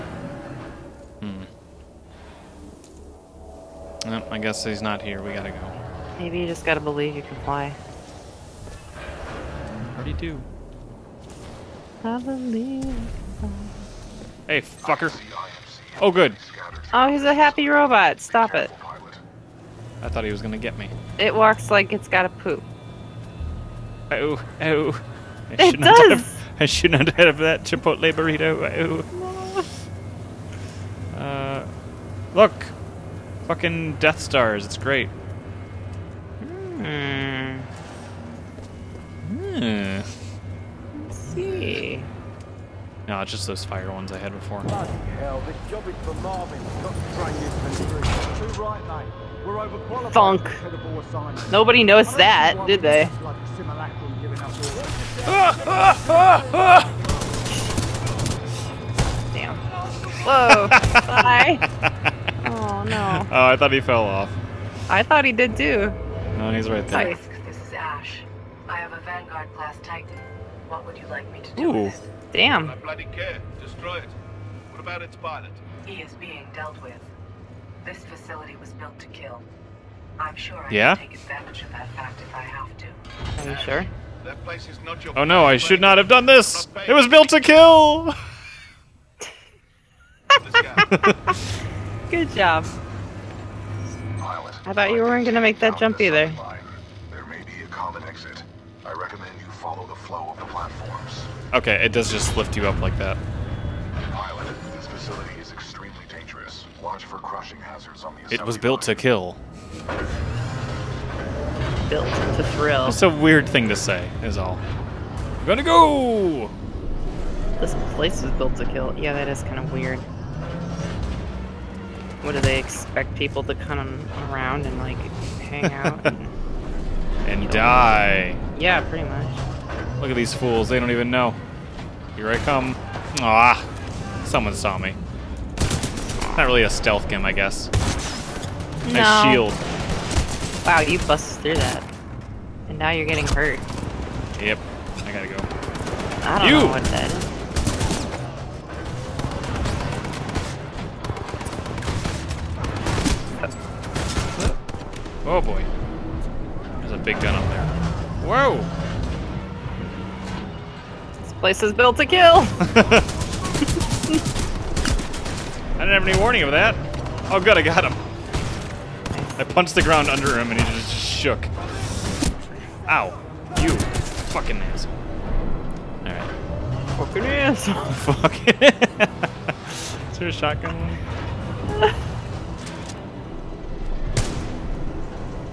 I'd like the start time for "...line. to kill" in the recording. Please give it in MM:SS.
01:48.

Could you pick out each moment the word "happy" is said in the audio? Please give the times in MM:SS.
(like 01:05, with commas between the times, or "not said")
00:17.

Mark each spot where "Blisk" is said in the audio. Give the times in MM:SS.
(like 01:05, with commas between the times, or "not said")
01:07.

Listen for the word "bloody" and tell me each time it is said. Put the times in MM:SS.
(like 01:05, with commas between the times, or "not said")
00:44, 01:12.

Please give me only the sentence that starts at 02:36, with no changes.
There's a big gun up there.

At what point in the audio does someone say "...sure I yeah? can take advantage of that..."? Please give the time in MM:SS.
01:20.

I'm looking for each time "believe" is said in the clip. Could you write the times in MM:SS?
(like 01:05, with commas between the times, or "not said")
00:06, 00:12.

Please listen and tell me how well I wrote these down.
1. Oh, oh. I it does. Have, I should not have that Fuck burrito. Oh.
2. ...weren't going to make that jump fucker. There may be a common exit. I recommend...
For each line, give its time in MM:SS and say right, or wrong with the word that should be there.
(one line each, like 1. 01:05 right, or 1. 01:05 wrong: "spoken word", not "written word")
1. 00:24 wrong: "Chipotle", not "Fuck"
2. 01:35 wrong: "either", not "fucker".